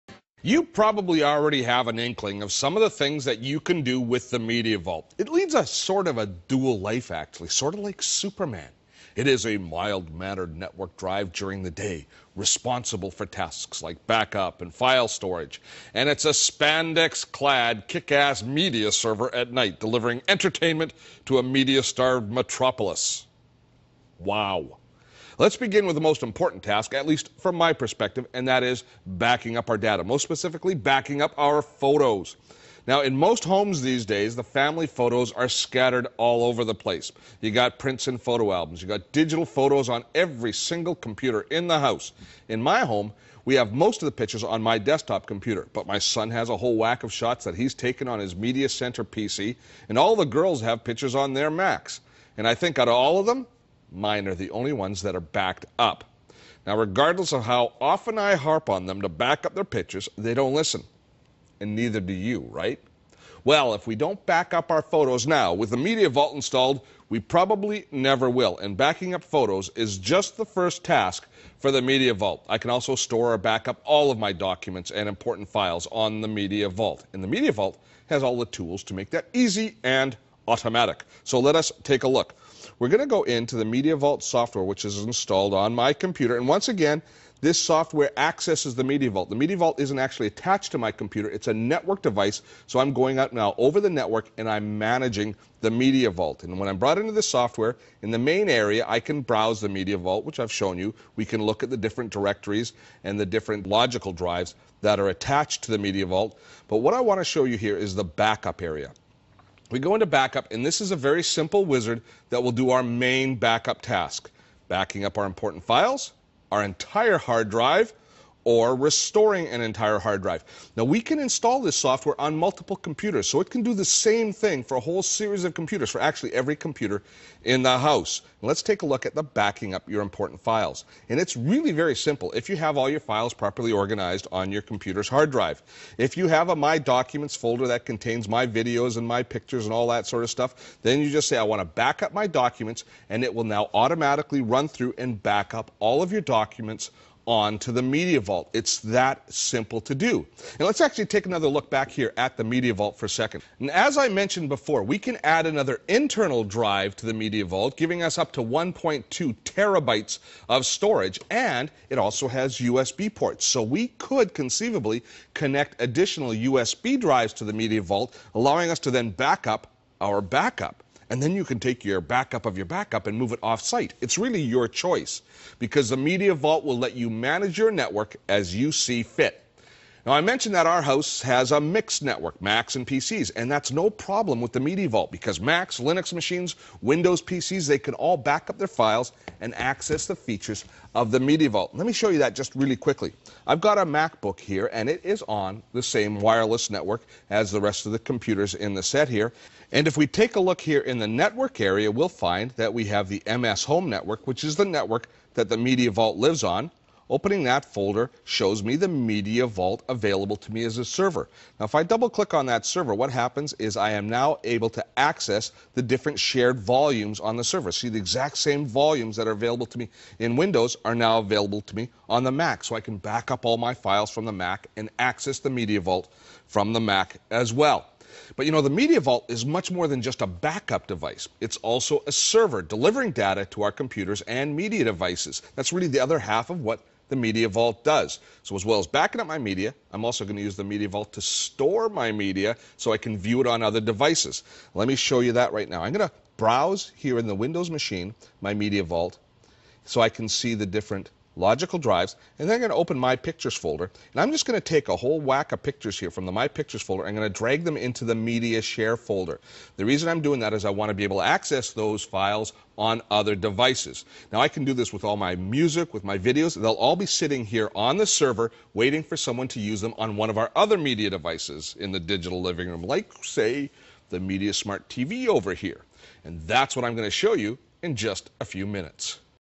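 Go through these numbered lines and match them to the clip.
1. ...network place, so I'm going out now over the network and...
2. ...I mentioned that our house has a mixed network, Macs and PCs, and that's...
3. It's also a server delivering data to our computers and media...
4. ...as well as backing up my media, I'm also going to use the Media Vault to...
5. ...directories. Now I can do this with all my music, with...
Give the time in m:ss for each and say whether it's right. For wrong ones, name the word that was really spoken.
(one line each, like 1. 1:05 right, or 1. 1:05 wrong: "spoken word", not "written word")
1. 1:31 wrong: "device", not "place"
2. 3:00 right
3. 3:51 right
4. 3:58 right
5. 4:23 wrong: "devices", not "directories".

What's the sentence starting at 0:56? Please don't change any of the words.
Now, regardless of how often I harp on them to back up their pitches, they don't listen.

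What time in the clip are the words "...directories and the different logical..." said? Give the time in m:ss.
1:42.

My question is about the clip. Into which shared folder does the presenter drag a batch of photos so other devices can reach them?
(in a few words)
media share folder.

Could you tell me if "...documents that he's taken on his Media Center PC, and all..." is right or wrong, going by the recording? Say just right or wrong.
wrong.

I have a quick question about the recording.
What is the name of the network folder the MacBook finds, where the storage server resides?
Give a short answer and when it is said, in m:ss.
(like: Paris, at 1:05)
MS Home Network, at 3:23.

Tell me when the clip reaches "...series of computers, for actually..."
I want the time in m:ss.
2:05.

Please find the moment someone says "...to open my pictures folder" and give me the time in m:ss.
4:12.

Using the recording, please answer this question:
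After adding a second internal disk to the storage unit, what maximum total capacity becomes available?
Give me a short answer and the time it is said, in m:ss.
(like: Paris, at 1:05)
1.2 terabytes, at 2:38.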